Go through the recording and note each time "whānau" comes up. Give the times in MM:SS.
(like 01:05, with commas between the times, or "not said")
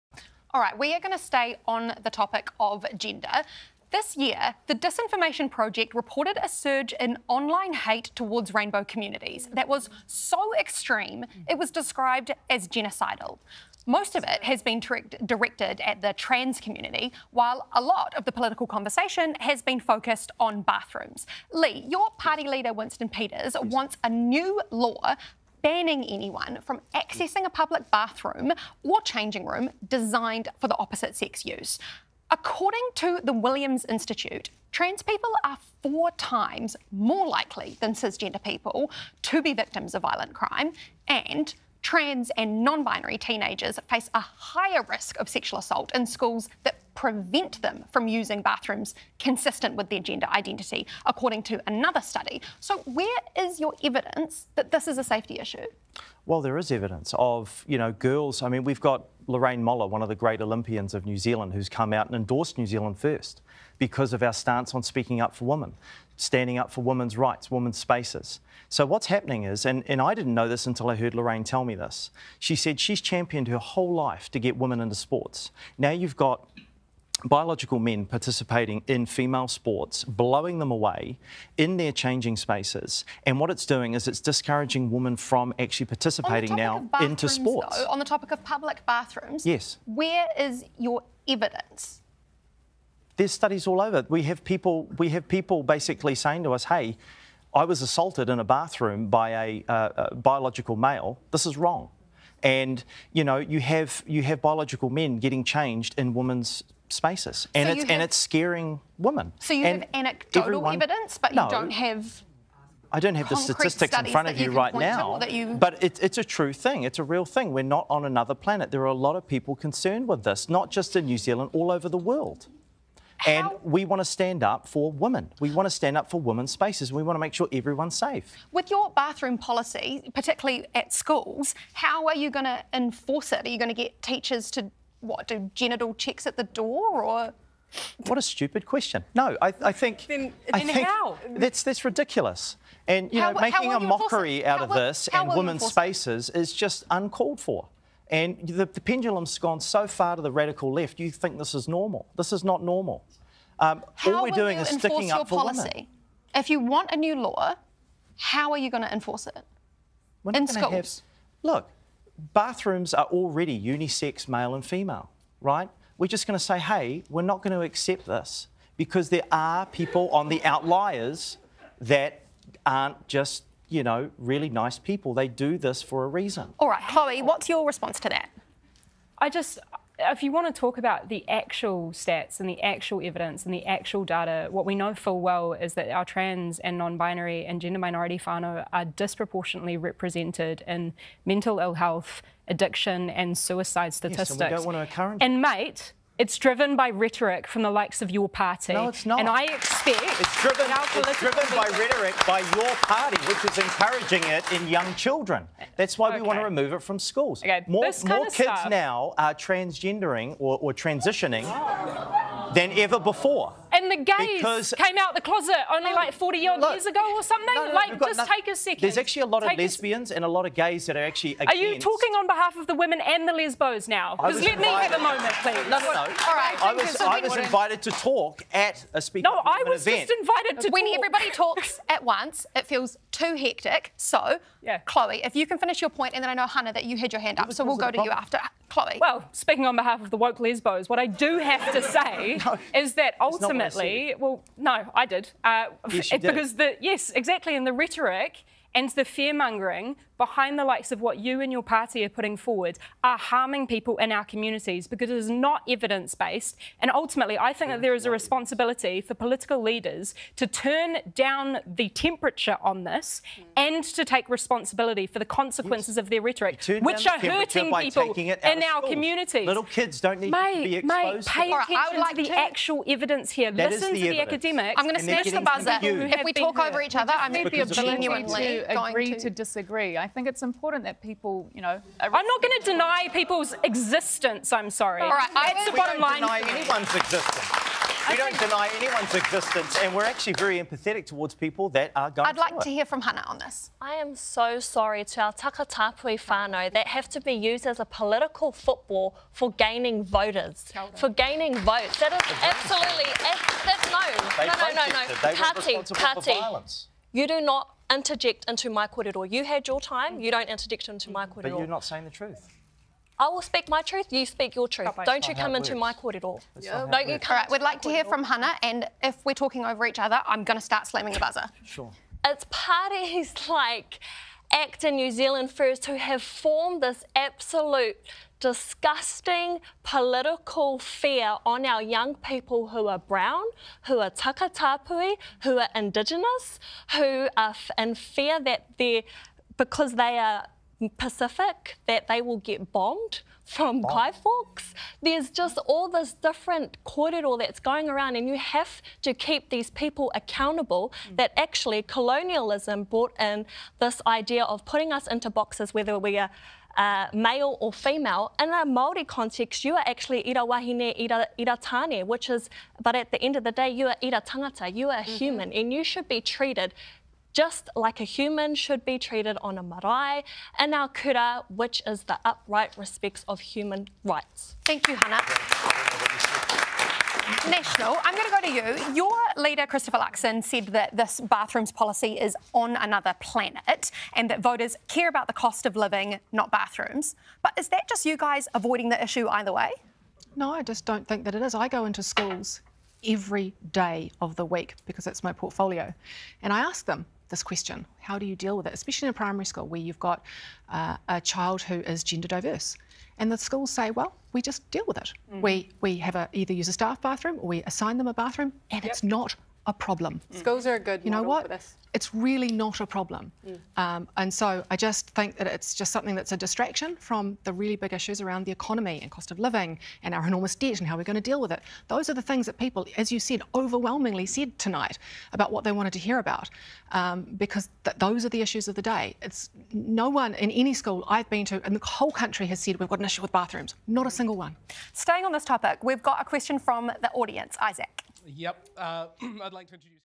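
03:08, 04:56.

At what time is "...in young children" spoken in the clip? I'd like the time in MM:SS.
03:24.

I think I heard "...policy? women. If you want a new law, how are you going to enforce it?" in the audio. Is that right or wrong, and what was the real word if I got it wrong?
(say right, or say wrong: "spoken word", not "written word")
right.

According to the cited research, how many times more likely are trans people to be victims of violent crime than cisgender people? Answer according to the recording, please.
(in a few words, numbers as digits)
4.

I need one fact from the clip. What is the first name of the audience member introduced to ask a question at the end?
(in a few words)
Isaac.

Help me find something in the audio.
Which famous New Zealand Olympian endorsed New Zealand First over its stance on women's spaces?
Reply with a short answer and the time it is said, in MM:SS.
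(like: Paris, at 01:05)
Lorraine Moller, at 00:59.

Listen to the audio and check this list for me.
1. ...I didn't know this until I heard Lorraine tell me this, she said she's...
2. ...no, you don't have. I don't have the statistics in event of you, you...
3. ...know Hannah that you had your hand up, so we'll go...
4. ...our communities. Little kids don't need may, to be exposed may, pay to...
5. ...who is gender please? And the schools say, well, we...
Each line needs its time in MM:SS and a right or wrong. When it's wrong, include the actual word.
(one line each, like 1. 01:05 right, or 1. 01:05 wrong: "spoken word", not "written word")
1. 01:10 right
2. 01:51 wrong: "front", not "event"
3. 03:56 right
4. 04:28 right
5. 06:41 wrong: "diverse", not "please".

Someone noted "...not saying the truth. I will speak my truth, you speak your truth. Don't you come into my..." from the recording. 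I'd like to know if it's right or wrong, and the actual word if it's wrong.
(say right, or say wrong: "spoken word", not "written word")
right.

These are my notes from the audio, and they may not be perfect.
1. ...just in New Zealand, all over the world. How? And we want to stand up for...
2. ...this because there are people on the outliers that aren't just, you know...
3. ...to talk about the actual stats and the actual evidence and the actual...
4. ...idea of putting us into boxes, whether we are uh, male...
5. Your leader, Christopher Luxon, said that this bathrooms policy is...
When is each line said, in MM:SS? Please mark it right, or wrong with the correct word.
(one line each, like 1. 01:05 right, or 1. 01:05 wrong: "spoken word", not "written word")
1. 02:00 right
2. 02:48 right
3. 03:00 right
4. 05:54 right
5. 06:18 right.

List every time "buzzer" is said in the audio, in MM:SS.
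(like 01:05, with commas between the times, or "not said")
04:35, 05:21.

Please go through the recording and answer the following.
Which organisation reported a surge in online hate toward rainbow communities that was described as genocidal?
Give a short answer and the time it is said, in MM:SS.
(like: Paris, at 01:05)
The Disinformation Project, at 00:04.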